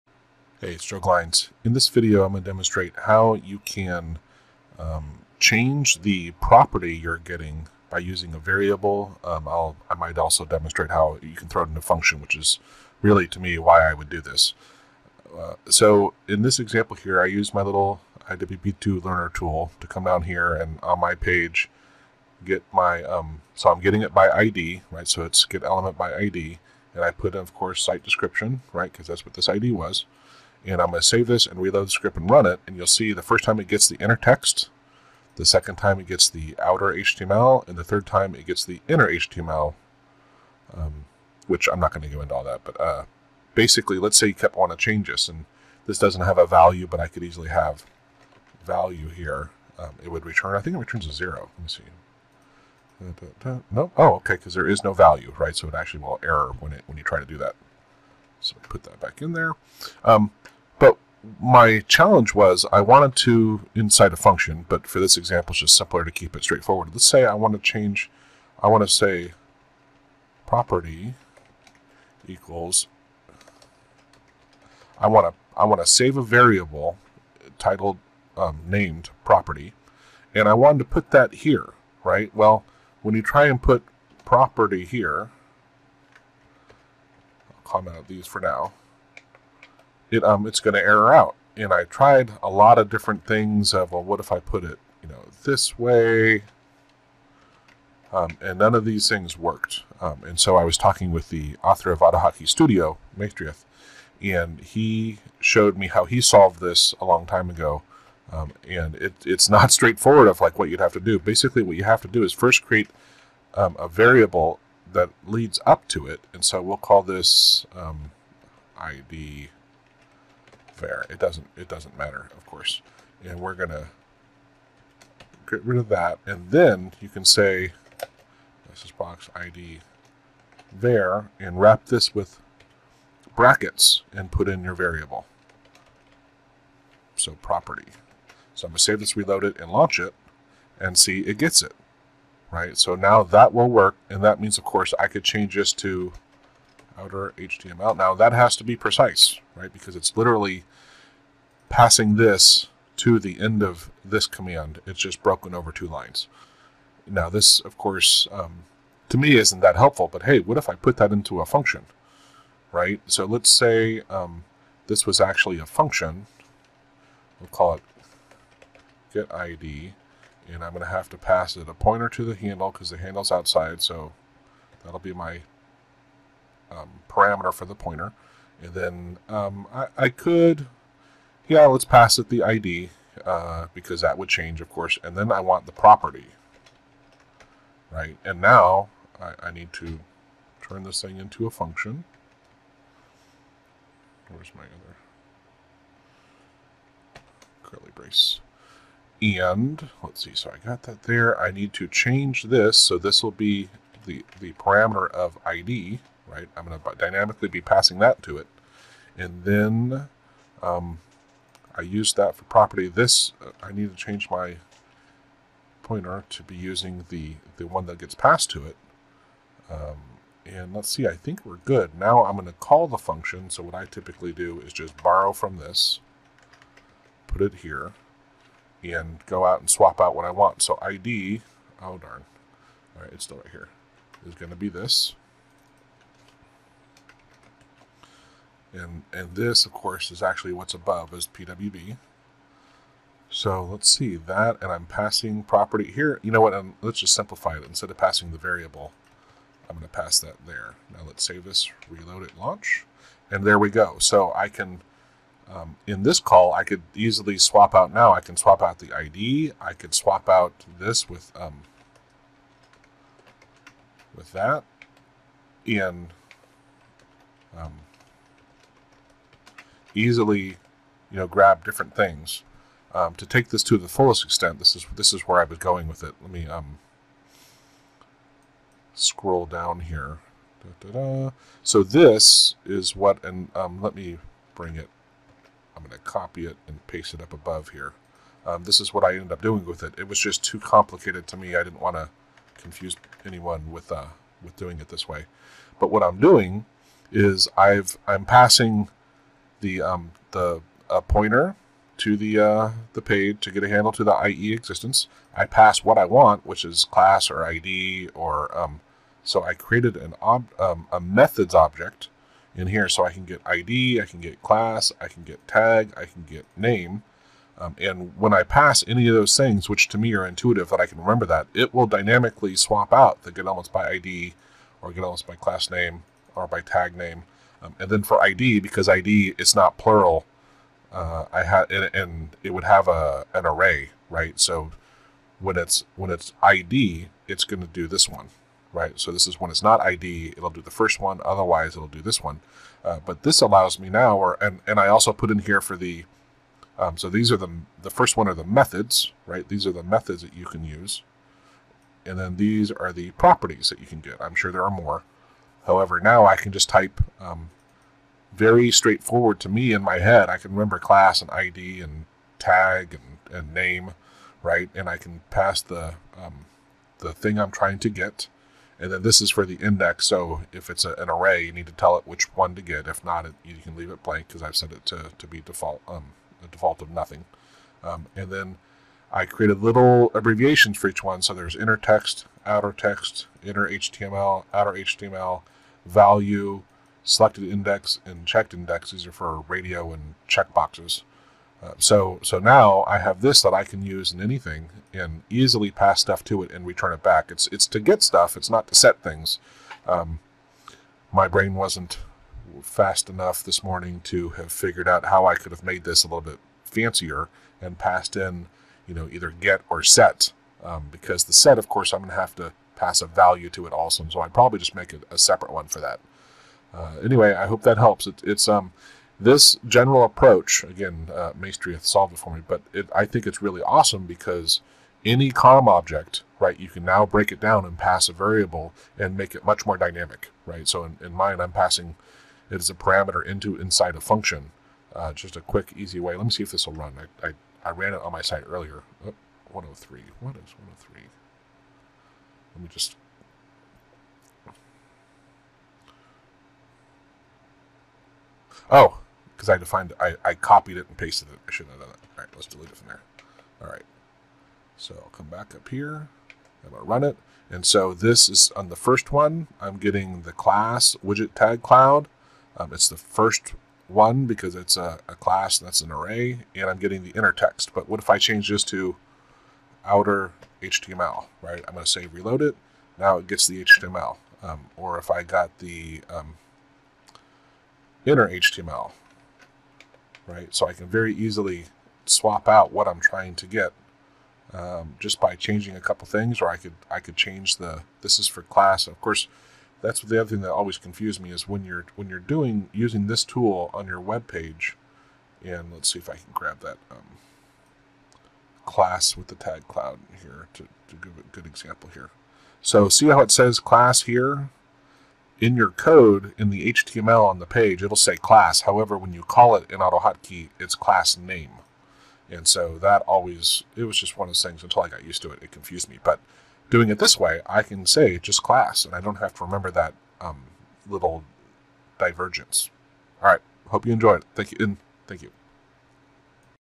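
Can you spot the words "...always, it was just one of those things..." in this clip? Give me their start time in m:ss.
8:33.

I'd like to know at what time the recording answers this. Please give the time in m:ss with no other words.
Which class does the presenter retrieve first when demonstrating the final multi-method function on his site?
7:41.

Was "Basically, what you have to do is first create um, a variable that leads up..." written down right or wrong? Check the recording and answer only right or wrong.
right.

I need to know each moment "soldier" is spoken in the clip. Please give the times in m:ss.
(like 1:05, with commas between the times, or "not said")
not said.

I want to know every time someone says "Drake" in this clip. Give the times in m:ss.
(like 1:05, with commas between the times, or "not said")
not said.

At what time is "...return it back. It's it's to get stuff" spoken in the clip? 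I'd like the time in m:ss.
6:36.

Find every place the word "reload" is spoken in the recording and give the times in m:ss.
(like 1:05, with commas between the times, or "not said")
0:31, 2:19, 4:11, 7:52.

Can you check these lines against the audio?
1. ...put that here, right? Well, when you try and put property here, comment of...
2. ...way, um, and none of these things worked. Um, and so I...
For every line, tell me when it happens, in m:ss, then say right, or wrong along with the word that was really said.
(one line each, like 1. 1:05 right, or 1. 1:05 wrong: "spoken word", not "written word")
1. 1:20 right
2. 1:35 right.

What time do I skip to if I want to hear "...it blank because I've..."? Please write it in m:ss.
6:13.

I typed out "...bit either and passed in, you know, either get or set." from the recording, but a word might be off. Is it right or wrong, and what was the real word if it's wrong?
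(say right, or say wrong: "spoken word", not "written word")
wrong: "fancier", not "either".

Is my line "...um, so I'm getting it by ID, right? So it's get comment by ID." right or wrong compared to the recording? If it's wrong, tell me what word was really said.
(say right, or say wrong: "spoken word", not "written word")
wrong: "element", not "comment".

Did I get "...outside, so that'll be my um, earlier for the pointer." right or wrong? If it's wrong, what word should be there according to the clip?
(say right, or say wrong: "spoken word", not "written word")
wrong: "parameter", not "earlier".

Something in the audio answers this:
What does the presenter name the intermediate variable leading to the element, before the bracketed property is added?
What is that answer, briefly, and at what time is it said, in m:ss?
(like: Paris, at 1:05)
ID var, at 1:58.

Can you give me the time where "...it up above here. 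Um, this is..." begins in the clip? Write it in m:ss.
4:47.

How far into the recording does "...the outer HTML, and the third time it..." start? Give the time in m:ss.
0:36.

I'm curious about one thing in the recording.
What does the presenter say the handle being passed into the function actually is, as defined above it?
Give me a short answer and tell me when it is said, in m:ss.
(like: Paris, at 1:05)
PWB, at 4:01.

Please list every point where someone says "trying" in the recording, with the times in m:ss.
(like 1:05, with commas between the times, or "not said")
6:07, 8:02.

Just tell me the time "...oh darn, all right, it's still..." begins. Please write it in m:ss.
3:51.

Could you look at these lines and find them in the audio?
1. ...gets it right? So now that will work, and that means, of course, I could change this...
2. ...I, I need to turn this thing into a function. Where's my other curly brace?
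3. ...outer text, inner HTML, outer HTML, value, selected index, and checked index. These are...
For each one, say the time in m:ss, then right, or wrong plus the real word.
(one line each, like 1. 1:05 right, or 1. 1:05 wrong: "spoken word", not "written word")
1. 2:21 right
2. 3:09 right
3. 6:22 right.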